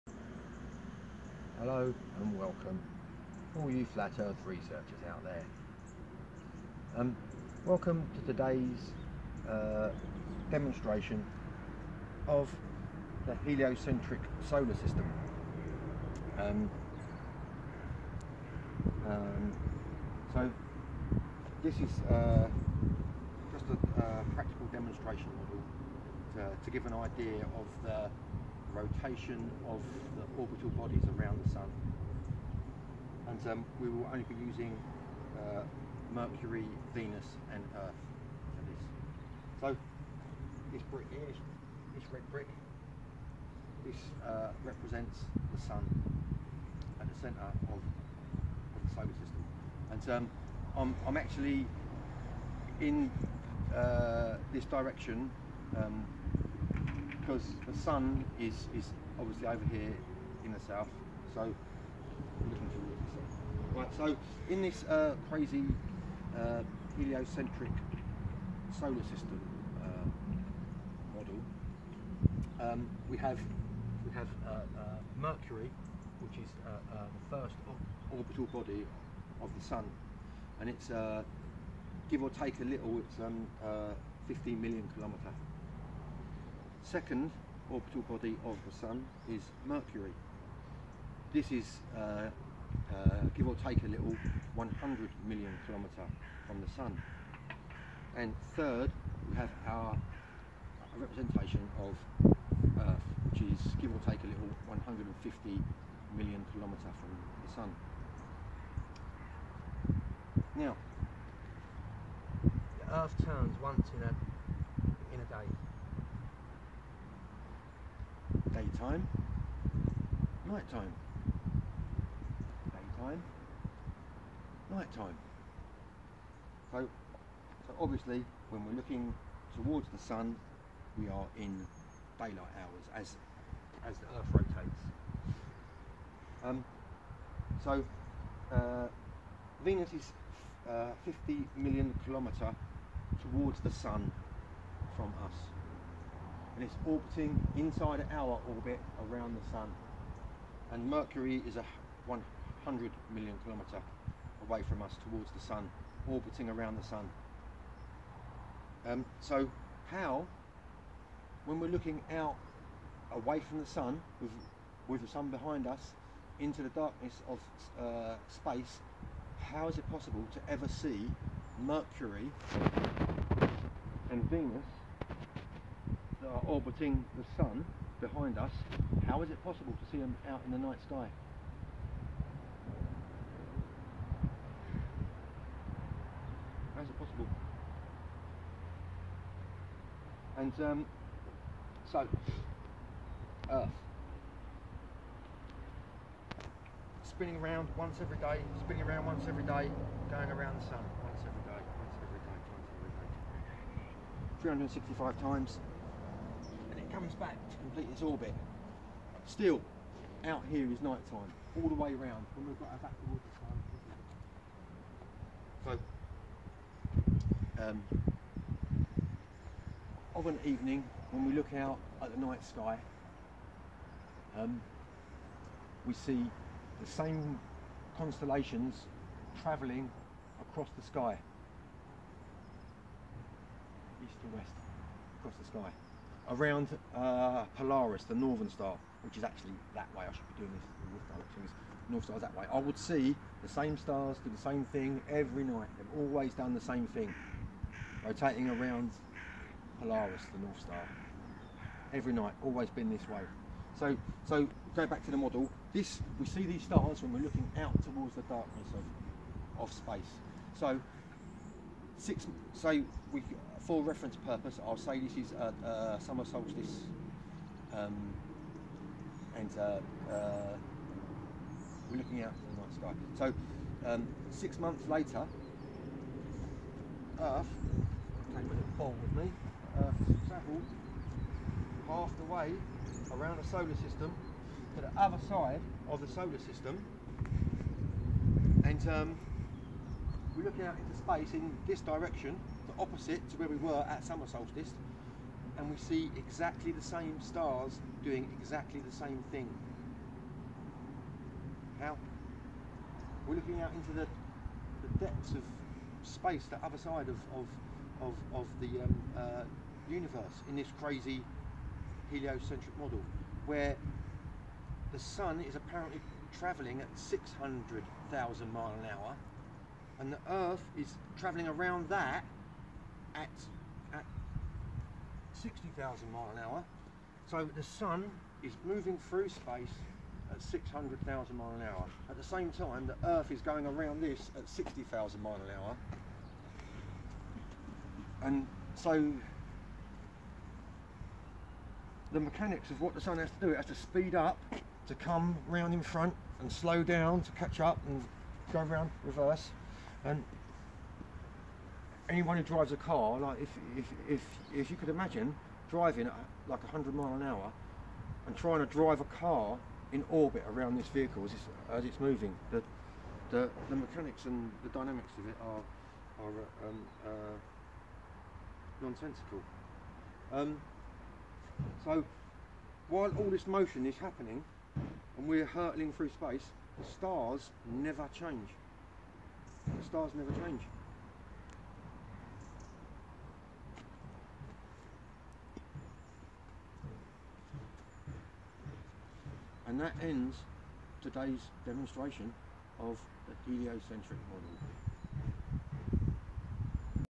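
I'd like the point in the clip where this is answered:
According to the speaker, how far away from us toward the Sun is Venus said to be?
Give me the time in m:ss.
2:21.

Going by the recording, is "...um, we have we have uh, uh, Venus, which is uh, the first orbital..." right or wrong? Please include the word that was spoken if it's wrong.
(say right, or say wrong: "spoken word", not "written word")
wrong: "Mercury", not "Venus".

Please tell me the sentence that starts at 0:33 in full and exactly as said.
And um, we will only be using uh, Mercury, Venus and Earth for this.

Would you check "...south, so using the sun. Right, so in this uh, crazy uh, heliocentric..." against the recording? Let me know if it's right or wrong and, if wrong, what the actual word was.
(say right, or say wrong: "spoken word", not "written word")
wrong: "looking", not "using".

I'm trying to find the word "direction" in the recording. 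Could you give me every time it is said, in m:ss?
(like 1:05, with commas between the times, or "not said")
0:54, 4:01, 4:51.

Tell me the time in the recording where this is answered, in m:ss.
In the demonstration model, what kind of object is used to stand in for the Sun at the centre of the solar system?
0:42.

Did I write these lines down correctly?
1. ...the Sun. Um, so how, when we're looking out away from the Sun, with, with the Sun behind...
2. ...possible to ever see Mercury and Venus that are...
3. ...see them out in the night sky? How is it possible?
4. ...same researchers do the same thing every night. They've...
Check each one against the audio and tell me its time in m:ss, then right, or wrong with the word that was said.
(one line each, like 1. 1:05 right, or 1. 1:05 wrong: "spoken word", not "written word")
1. 2:36 right
2. 2:49 right
3. 2:59 right
4. 4:03 wrong: "stars", not "researchers".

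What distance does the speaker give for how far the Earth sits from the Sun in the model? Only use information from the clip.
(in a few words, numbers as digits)
150 million kilometres.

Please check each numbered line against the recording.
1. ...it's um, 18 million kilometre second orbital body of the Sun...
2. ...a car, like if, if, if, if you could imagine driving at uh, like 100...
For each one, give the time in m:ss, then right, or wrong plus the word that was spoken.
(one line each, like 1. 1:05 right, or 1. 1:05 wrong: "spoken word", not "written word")
1. 1:22 wrong: "15", not "18"
2. 5:52 right.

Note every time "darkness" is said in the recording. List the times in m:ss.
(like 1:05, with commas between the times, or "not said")
2:46, 4:18.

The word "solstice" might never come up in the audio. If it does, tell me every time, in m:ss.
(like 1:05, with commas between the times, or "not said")
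4:26, 4:54.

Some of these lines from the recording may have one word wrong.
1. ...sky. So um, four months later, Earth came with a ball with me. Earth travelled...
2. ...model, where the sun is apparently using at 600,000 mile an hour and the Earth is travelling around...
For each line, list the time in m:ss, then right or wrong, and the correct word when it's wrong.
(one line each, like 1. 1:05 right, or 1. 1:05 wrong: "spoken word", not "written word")
1. 4:32 wrong: "six", not "four"
2. 5:12 wrong: "travelling", not "using".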